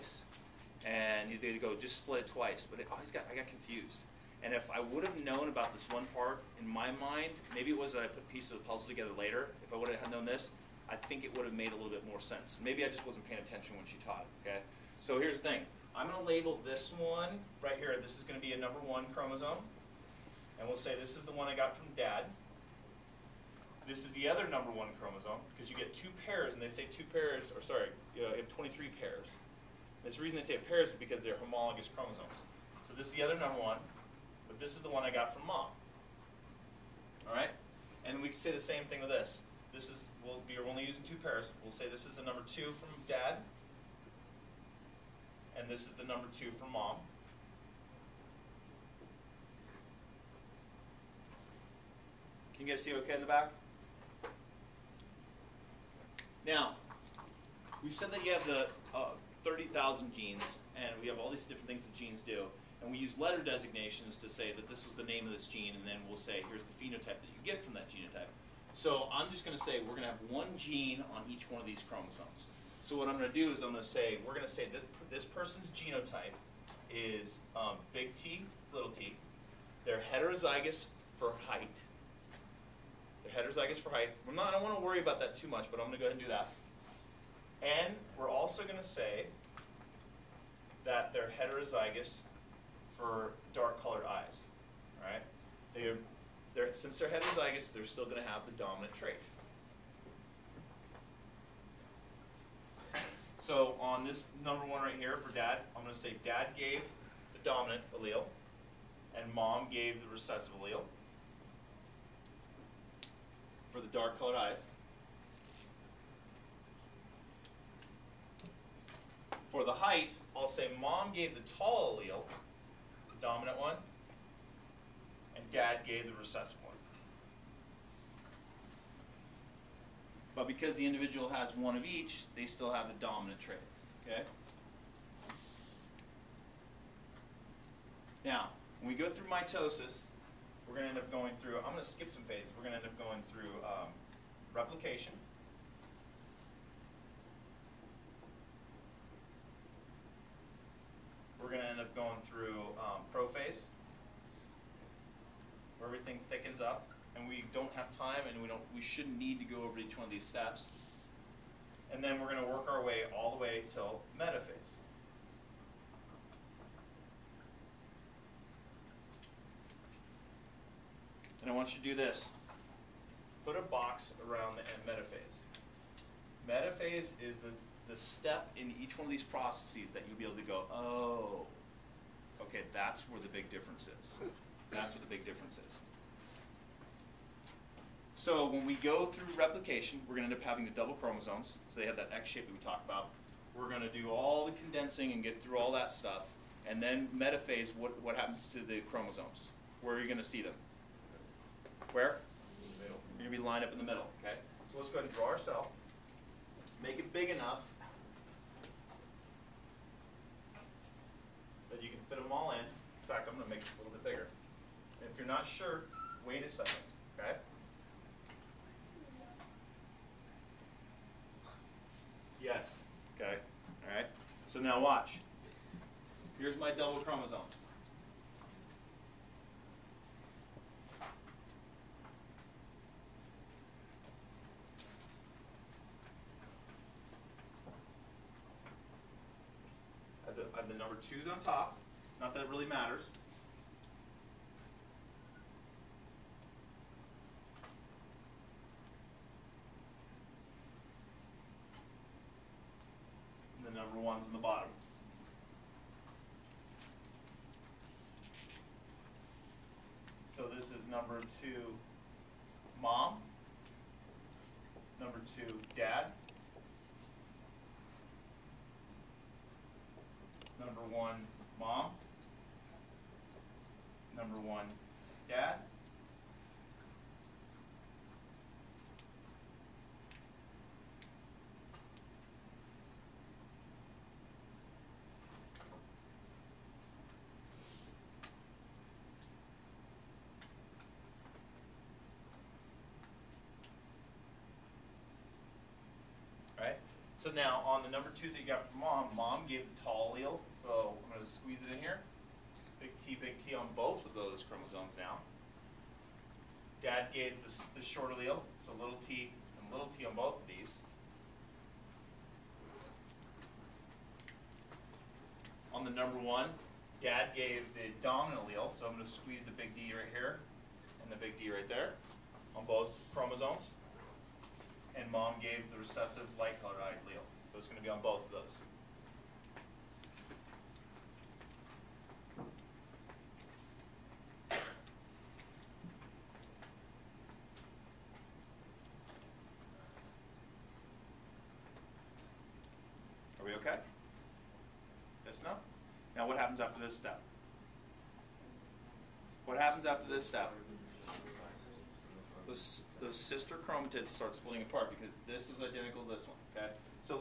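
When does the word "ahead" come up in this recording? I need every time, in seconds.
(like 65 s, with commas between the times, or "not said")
86 s, 204 s.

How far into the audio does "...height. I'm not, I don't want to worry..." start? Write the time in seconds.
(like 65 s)
83 s.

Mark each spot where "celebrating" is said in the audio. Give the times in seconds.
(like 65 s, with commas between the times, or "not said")
not said.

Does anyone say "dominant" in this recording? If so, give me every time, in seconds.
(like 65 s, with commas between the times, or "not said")
98 s, 107 s, 123 s, 133 s, 318 s.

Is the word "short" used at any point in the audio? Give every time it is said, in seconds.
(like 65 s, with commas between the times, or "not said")
307 s.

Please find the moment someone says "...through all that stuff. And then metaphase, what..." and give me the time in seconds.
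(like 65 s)
195 s.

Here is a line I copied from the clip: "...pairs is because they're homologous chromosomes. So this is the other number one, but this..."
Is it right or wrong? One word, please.
right.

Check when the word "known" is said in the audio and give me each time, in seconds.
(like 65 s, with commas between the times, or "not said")
5 s, 10 s.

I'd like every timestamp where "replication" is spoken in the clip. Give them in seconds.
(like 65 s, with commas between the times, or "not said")
144 s, 189 s.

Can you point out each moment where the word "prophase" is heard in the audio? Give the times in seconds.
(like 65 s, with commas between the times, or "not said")
153 s.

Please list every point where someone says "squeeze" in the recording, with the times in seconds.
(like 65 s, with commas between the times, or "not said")
301 s, 319 s.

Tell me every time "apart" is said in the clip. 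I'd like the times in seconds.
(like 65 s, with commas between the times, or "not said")
354 s.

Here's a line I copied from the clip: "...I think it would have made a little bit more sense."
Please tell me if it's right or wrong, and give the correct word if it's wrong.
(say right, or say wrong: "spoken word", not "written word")
right.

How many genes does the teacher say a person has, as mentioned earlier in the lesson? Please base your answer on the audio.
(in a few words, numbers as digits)
30,000.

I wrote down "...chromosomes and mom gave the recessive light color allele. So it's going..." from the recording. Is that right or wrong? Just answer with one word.
right.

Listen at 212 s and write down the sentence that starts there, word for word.
In fact, I'm going to make this a little bit bigger.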